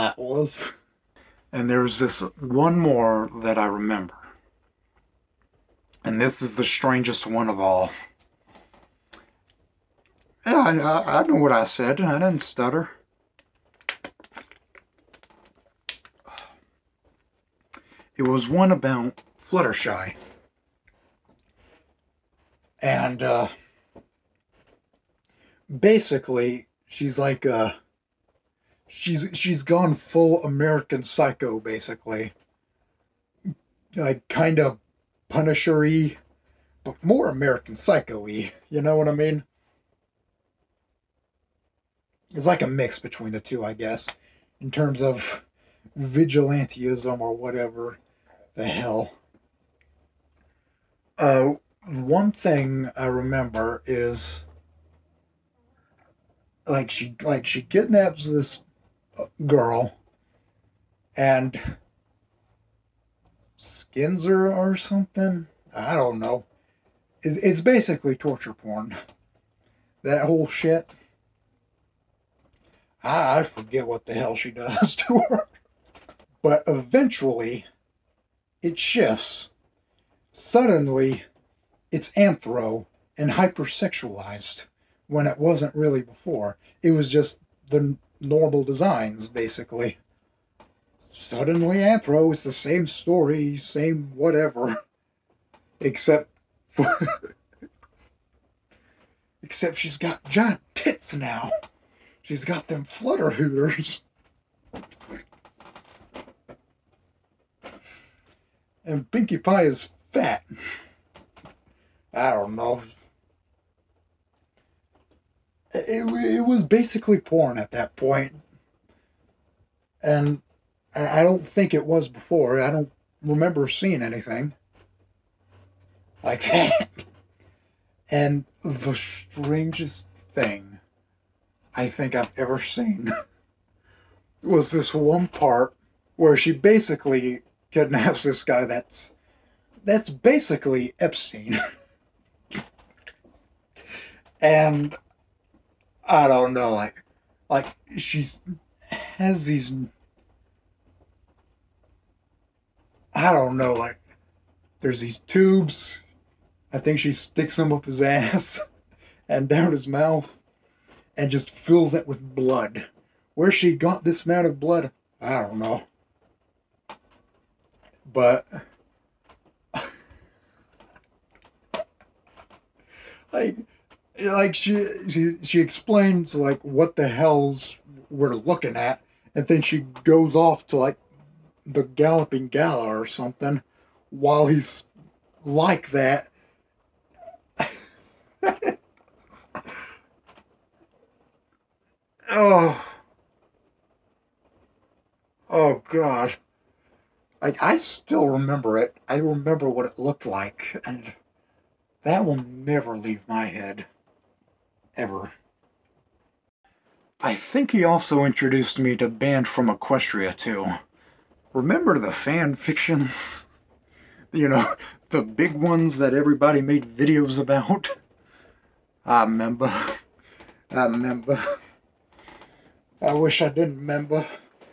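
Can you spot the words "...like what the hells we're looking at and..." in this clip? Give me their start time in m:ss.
2:56.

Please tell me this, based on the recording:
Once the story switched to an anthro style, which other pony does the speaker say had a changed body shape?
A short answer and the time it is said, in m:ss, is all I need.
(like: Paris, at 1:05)
Pinkie Pie, at 1:49.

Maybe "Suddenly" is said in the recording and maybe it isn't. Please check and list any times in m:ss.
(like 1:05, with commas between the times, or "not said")
1:20, 1:31.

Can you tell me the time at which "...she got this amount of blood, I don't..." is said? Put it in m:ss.
2:43.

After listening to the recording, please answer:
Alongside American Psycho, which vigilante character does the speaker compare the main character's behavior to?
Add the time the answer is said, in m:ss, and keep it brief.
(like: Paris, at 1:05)
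Punisher, at 0:35.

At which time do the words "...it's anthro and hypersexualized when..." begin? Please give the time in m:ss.
1:21.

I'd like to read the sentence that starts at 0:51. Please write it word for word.
Uh, one thing I remember is like she like she kidnaps this uh, girl and Skinzer or something.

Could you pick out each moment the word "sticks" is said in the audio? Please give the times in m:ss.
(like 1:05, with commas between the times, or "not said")
2:37.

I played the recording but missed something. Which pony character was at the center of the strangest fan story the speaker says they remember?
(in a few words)
Fluttershy.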